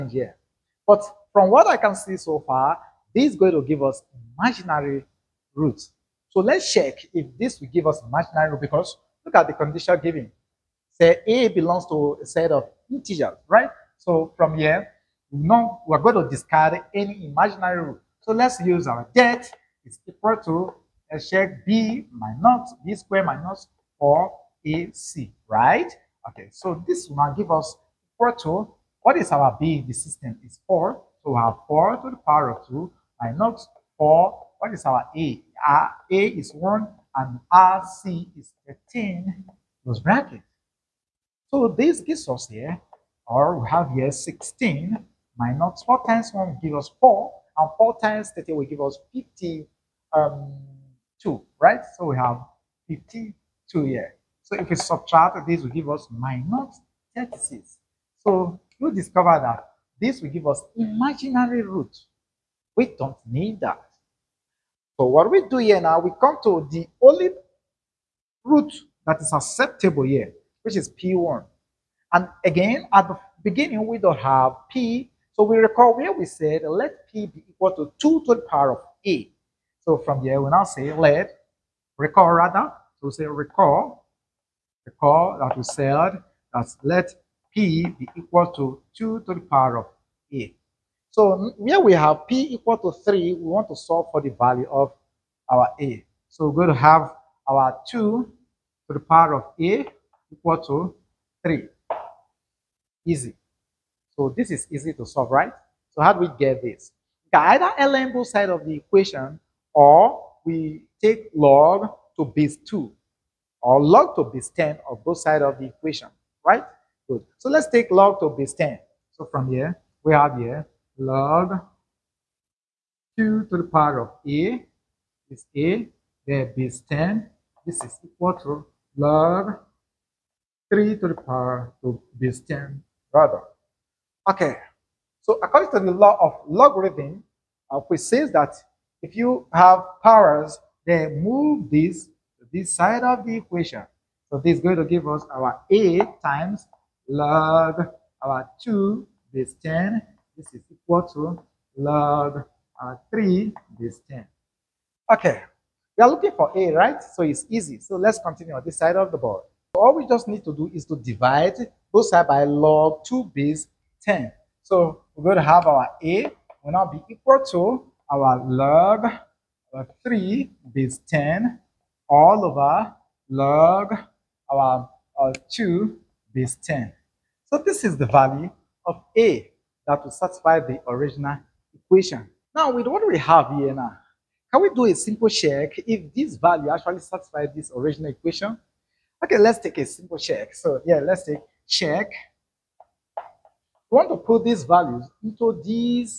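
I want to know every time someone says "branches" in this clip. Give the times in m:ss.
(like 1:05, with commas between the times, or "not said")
not said.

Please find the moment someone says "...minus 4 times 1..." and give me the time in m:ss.
0:45.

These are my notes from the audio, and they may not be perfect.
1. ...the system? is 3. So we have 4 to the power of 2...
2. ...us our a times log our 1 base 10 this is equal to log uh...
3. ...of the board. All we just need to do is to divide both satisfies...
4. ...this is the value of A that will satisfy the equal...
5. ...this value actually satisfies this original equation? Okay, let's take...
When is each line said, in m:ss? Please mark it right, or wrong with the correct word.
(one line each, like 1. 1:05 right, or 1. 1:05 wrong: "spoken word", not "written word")
1. 0:29 wrong: "4", not "3"
2. 2:25 wrong: "2", not "1"
3. 2:38 wrong: "sides", not "satisfies"
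4. 2:57 wrong: "original", not "equal"
5. 3:06 right.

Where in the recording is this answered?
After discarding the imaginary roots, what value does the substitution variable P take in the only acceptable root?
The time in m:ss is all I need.
1:32.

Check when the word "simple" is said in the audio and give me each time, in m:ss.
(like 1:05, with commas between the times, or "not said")
3:04, 3:09.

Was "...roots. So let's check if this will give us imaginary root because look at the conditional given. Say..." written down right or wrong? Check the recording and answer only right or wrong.
right.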